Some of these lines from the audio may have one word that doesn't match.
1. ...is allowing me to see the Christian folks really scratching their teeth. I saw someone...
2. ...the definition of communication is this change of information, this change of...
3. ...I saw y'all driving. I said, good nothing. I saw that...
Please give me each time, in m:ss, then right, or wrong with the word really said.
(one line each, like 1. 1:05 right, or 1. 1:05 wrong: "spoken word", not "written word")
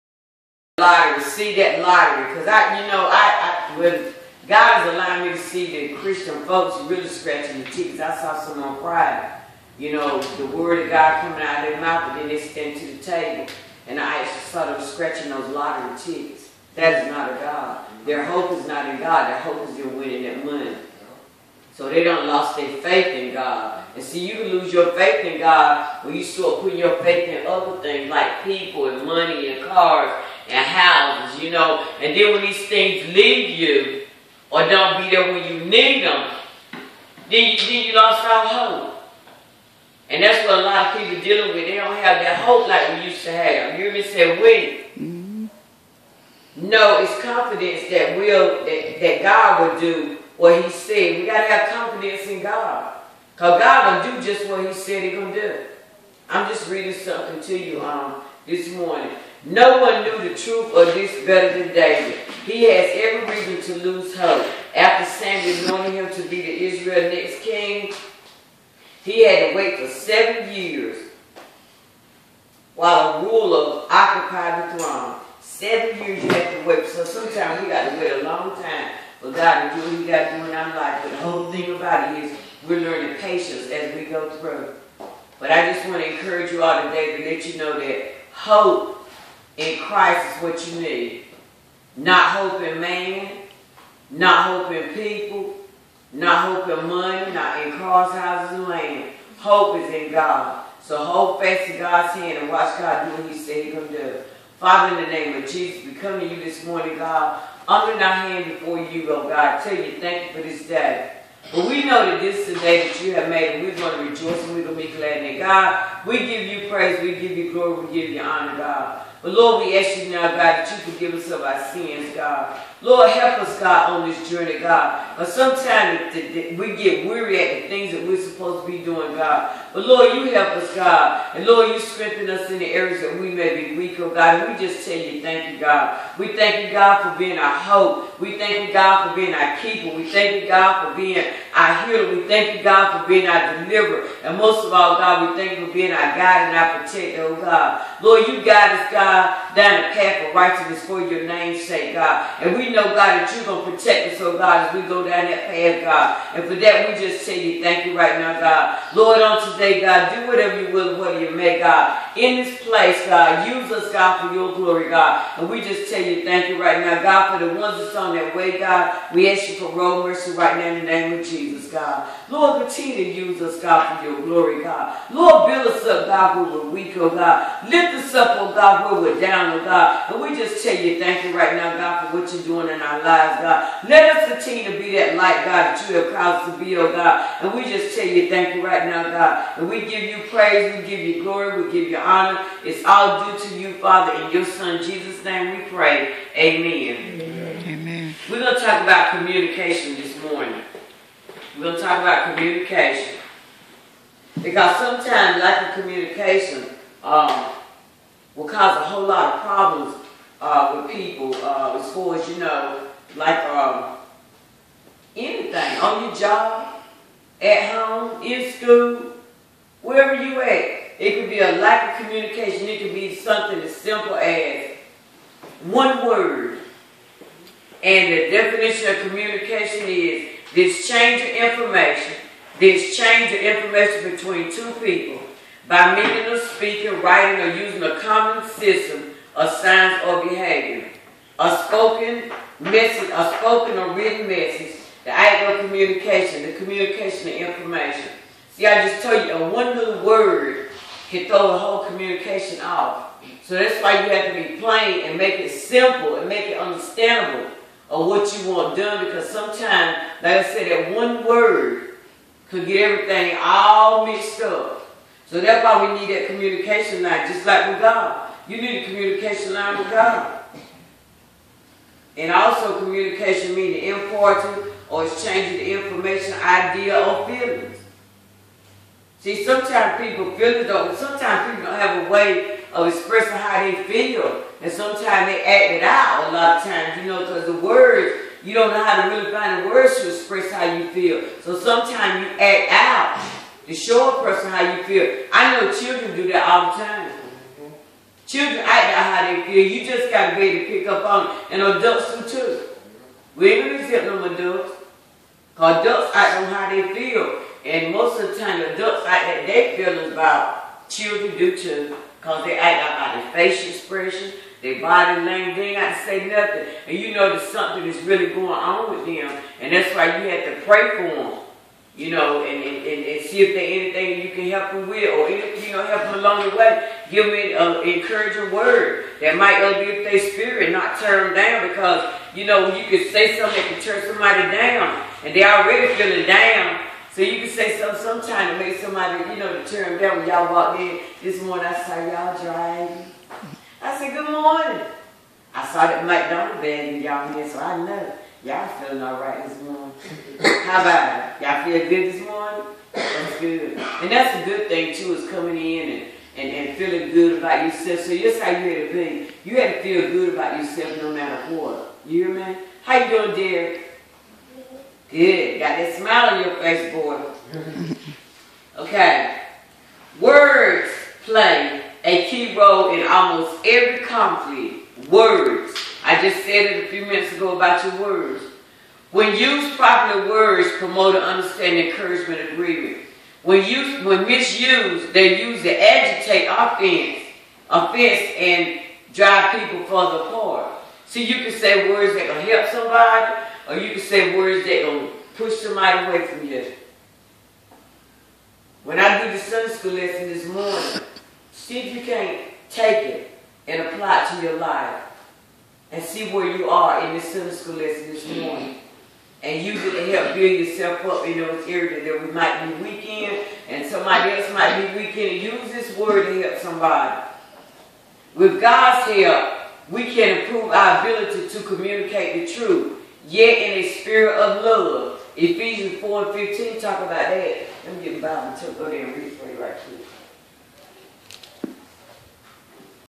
1. 0:04 right
2. 3:48 right
3. 5:41 wrong: "morning", not "nothing".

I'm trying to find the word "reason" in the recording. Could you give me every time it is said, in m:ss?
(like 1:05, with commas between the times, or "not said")
1:03.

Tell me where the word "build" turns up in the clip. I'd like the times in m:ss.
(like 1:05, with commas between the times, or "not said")
2:55, 6:50.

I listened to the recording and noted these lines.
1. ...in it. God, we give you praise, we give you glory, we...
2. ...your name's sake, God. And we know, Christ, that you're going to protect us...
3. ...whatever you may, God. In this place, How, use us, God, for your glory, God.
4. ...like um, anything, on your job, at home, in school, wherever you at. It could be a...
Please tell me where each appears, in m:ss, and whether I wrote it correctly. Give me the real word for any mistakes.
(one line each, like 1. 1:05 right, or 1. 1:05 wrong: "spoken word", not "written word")
1. 1:55 right
2. 2:31 wrong: "God", not "Christ"
3. 2:40 wrong: "God", not "How"
4. 3:33 right.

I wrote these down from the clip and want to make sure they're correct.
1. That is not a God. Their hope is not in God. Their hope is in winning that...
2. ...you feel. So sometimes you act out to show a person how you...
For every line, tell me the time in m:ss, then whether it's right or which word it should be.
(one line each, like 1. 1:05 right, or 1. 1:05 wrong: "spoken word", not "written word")
1. 0:16 right
2. 4:50 right.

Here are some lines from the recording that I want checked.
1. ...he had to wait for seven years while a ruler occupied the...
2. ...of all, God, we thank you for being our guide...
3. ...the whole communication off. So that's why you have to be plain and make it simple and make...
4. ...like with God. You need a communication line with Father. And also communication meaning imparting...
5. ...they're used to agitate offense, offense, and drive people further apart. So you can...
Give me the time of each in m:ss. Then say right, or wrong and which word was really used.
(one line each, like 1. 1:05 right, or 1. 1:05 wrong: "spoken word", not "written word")
1. 1:09 right
2. 2:24 right
3. 4:11 right
4. 4:27 wrong: "God", not "Father"
5. 6:25 right.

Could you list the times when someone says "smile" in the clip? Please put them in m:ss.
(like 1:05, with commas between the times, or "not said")
6:05.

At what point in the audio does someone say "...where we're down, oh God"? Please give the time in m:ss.
2:58.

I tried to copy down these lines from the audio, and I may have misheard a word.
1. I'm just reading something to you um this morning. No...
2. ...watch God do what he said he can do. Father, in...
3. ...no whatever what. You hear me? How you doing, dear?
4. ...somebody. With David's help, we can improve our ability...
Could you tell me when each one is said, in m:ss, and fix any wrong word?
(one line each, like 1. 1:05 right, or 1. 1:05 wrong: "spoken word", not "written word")
1. 0:56 right
2. 1:42 right
3. 6:01 wrong: "matter", not "whatever"
4. 6:56 wrong: "God", not "David".